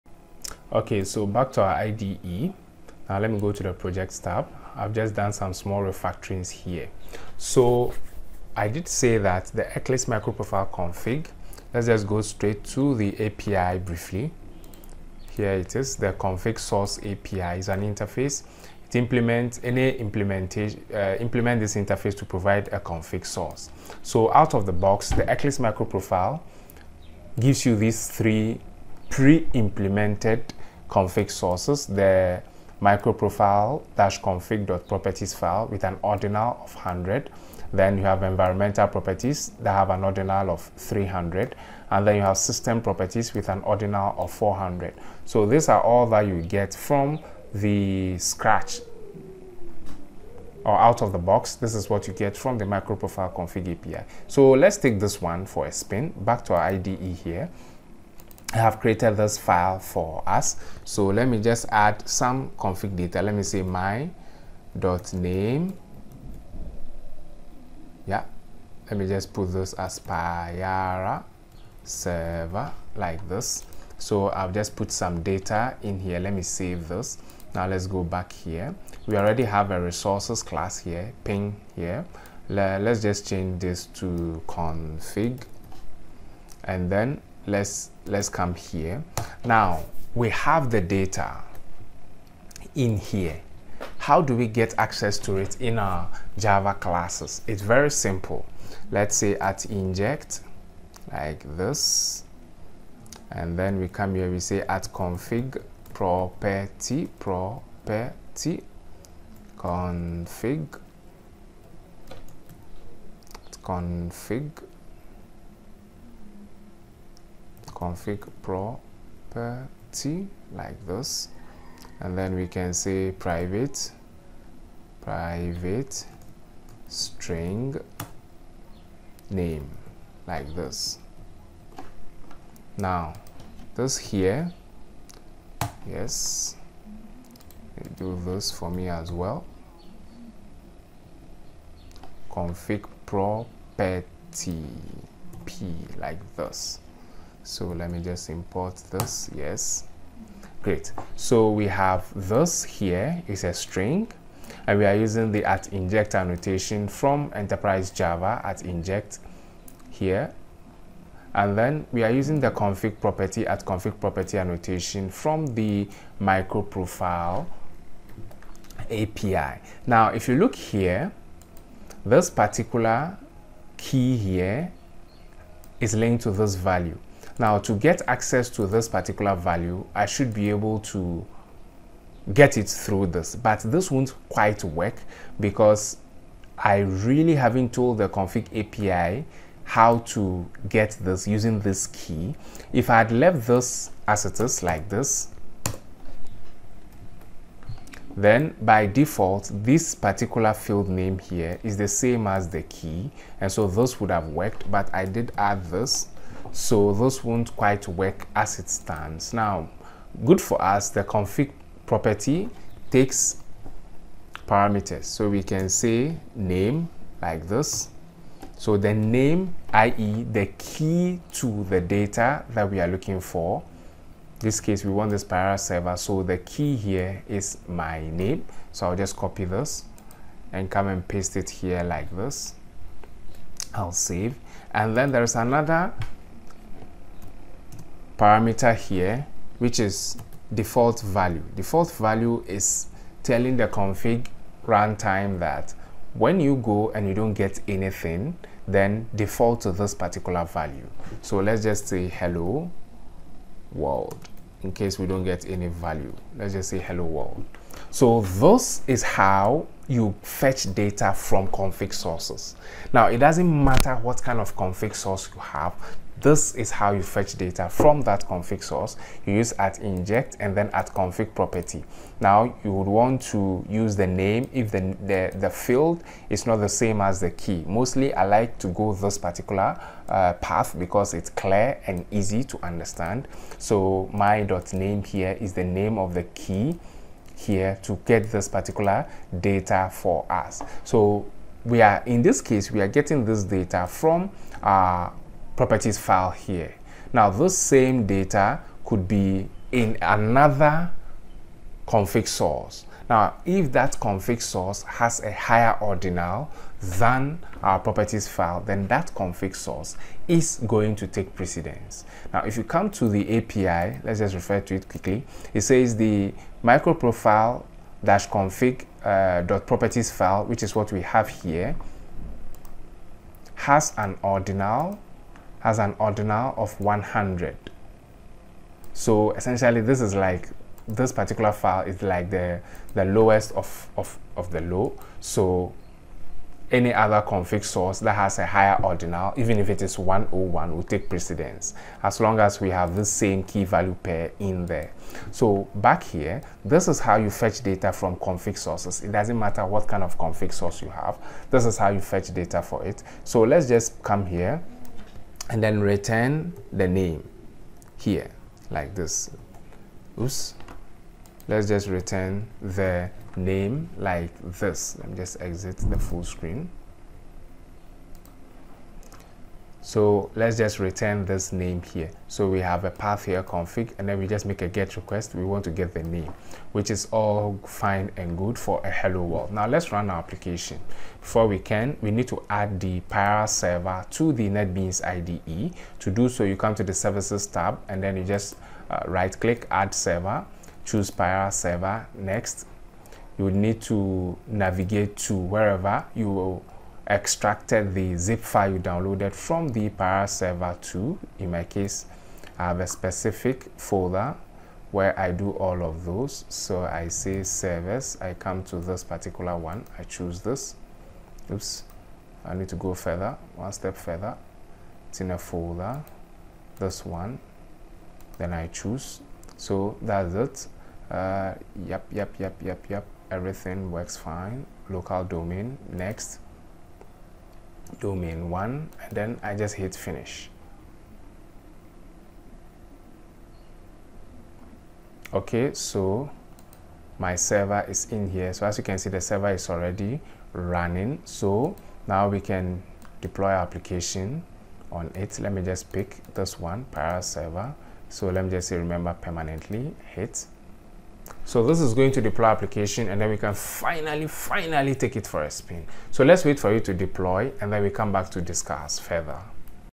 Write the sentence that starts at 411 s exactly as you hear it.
Oops, I need to go further, one step further.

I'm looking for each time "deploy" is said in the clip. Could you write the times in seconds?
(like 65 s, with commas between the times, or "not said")
443 s, 452 s, 456 s.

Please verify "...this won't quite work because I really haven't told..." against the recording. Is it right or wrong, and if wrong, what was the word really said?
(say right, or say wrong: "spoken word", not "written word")
right.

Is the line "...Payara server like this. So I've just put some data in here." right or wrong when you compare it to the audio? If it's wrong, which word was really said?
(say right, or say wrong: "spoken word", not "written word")
right.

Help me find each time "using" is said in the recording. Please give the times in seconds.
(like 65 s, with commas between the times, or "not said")
154 s, 162 s, 191 s.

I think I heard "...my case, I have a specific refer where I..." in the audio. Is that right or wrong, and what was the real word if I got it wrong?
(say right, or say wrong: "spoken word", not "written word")
wrong: "folder", not "refer".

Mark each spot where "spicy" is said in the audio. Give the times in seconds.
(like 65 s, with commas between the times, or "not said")
not said.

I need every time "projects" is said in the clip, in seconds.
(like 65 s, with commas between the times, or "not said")
3 s.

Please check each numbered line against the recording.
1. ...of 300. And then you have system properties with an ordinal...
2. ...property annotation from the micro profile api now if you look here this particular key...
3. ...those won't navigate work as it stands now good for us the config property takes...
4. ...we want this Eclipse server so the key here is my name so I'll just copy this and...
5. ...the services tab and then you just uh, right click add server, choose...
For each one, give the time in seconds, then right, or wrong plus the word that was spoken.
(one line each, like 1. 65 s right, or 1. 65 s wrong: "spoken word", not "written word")
1. 40 s right
2. 163 s right
3. 206 s wrong: "quite", not "navigate"
4. 224 s wrong: "Payara", not "Eclipse"
5. 386 s right.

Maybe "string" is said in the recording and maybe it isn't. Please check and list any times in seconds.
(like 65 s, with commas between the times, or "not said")
126 s, 153 s.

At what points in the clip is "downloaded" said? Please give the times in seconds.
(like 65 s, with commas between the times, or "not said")
398 s.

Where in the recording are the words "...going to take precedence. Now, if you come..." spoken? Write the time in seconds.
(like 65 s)
310 s.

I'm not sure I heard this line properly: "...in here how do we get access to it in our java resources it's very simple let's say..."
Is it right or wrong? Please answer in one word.
wrong.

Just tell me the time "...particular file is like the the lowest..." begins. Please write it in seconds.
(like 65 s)
331 s.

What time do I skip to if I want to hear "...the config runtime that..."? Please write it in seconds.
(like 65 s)
243 s.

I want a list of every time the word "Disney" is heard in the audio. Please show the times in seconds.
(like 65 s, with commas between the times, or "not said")
not said.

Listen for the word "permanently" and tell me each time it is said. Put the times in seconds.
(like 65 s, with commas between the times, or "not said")
449 s.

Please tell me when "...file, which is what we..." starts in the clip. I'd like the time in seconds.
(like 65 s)
320 s.